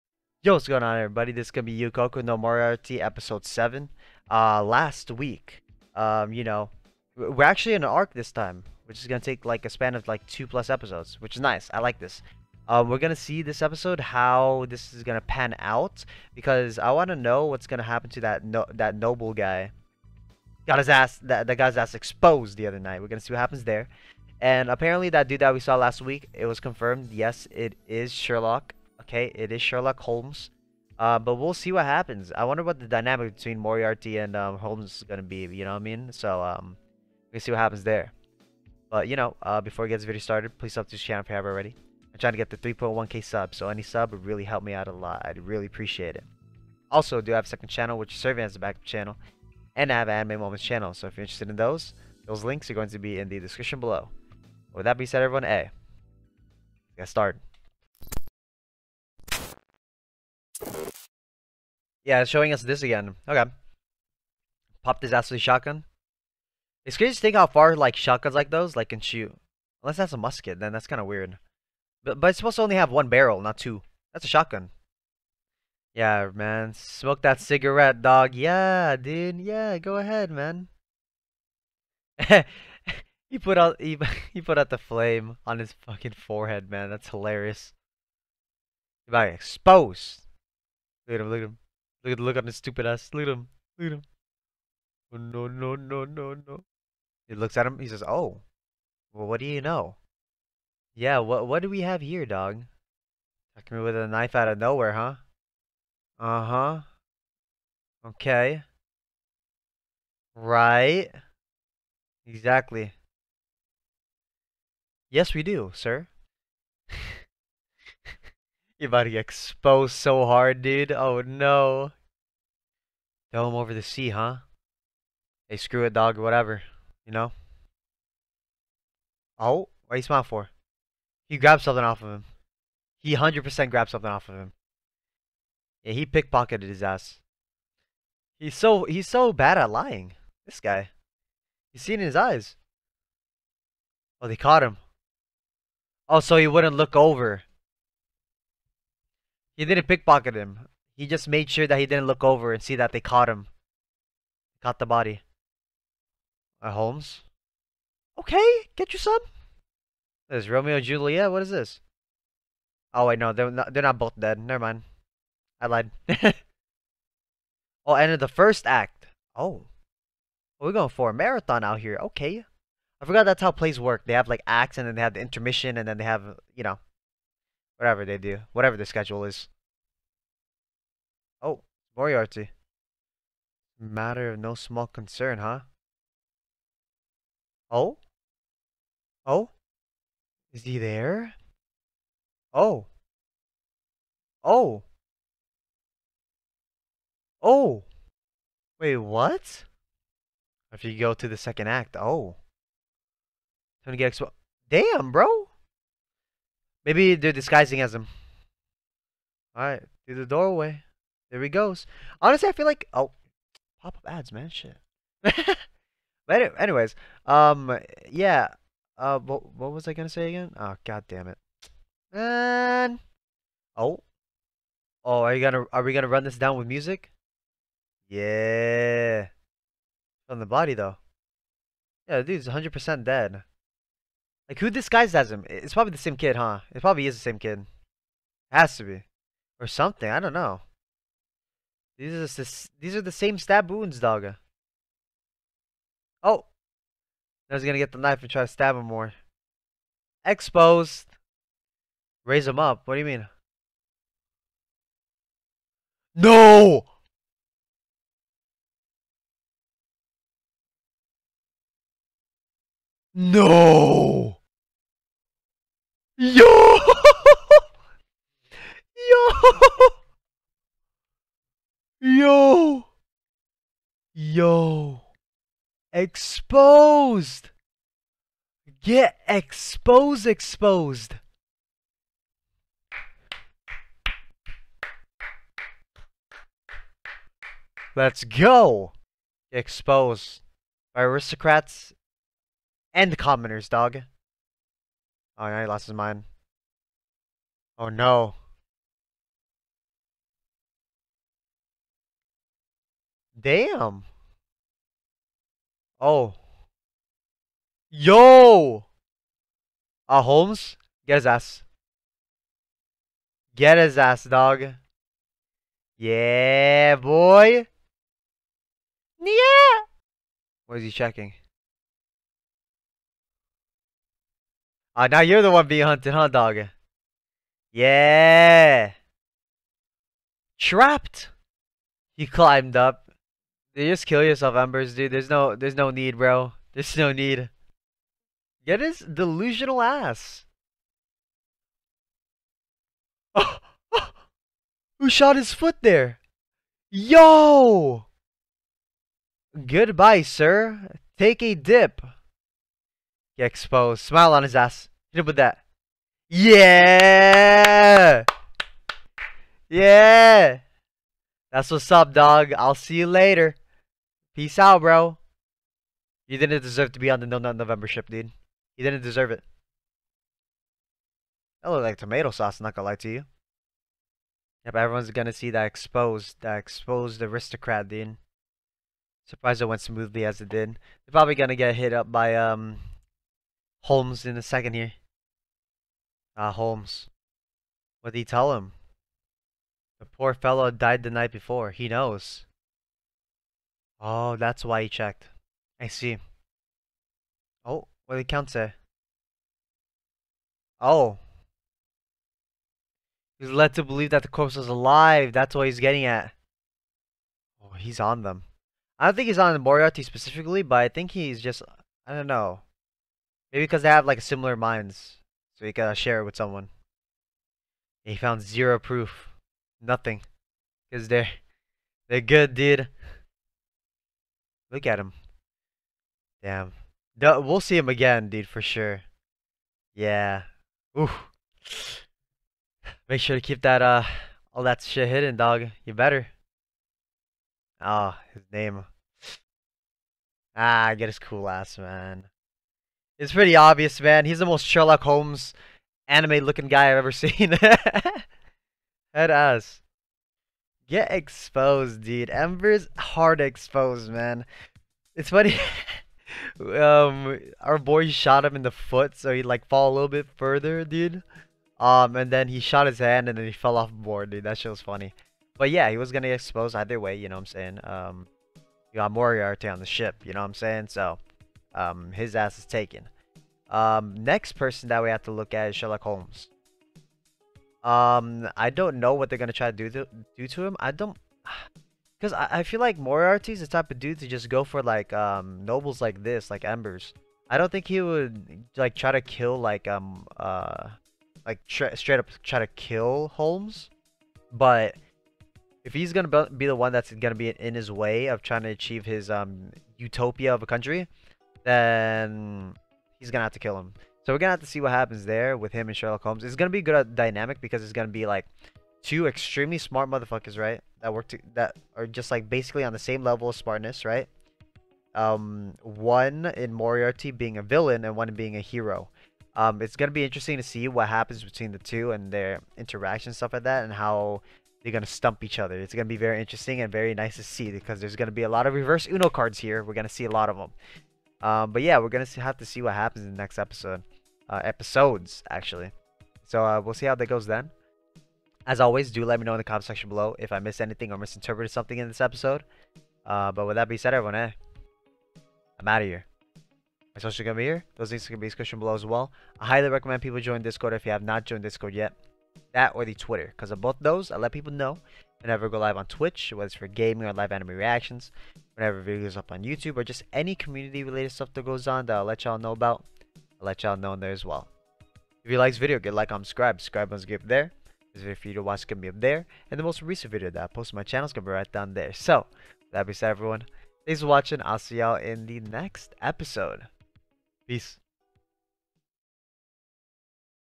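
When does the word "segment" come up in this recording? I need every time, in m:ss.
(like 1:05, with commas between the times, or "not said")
not said.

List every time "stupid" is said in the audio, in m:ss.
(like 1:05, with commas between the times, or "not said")
1:32.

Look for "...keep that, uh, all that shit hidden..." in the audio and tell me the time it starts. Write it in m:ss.
7:13.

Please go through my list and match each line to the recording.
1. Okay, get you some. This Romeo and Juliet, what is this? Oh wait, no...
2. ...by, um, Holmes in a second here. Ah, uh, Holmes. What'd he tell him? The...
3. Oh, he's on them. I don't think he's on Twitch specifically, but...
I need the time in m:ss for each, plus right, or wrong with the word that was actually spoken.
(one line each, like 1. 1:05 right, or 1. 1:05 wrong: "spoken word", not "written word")
1. 2:38 right
2. 6:22 right
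3. 6:47 wrong: "Moriarty", not "Twitch".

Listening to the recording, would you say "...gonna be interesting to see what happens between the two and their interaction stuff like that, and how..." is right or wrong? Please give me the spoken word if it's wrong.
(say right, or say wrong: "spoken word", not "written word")
right.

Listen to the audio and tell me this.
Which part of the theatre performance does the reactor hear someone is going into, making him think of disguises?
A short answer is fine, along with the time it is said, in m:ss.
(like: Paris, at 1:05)
second act, at 3:21.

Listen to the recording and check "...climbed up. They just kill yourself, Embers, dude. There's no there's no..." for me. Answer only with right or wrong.
right.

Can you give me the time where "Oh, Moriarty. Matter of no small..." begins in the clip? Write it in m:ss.
3:01.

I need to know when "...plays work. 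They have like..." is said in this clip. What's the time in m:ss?
2:53.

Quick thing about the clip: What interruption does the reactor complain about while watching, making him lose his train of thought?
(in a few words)
pop-up ads.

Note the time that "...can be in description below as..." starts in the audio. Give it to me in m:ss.
9:08.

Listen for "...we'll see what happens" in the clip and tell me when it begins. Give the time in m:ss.
0:31.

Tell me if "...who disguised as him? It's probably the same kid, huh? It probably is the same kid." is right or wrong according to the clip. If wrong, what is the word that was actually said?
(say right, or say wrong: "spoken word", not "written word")
right.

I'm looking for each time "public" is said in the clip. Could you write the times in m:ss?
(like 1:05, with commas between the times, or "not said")
not said.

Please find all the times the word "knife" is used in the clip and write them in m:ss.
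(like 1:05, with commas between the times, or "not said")
1:44, 4:07.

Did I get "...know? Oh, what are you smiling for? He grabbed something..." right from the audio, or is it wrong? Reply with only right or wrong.
right.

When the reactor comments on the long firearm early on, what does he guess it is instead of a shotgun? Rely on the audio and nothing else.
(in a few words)
musket.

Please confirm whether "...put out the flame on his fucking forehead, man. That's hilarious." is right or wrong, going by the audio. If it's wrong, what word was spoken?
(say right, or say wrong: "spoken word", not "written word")
right.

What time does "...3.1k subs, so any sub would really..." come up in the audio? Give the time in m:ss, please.
0:42.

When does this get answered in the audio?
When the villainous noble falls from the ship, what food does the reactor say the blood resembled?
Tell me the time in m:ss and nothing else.
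6:11.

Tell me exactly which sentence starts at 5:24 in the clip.
Ah, uh, now you're the one being hunted, huh, dog?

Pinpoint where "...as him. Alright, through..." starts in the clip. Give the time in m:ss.
3:27.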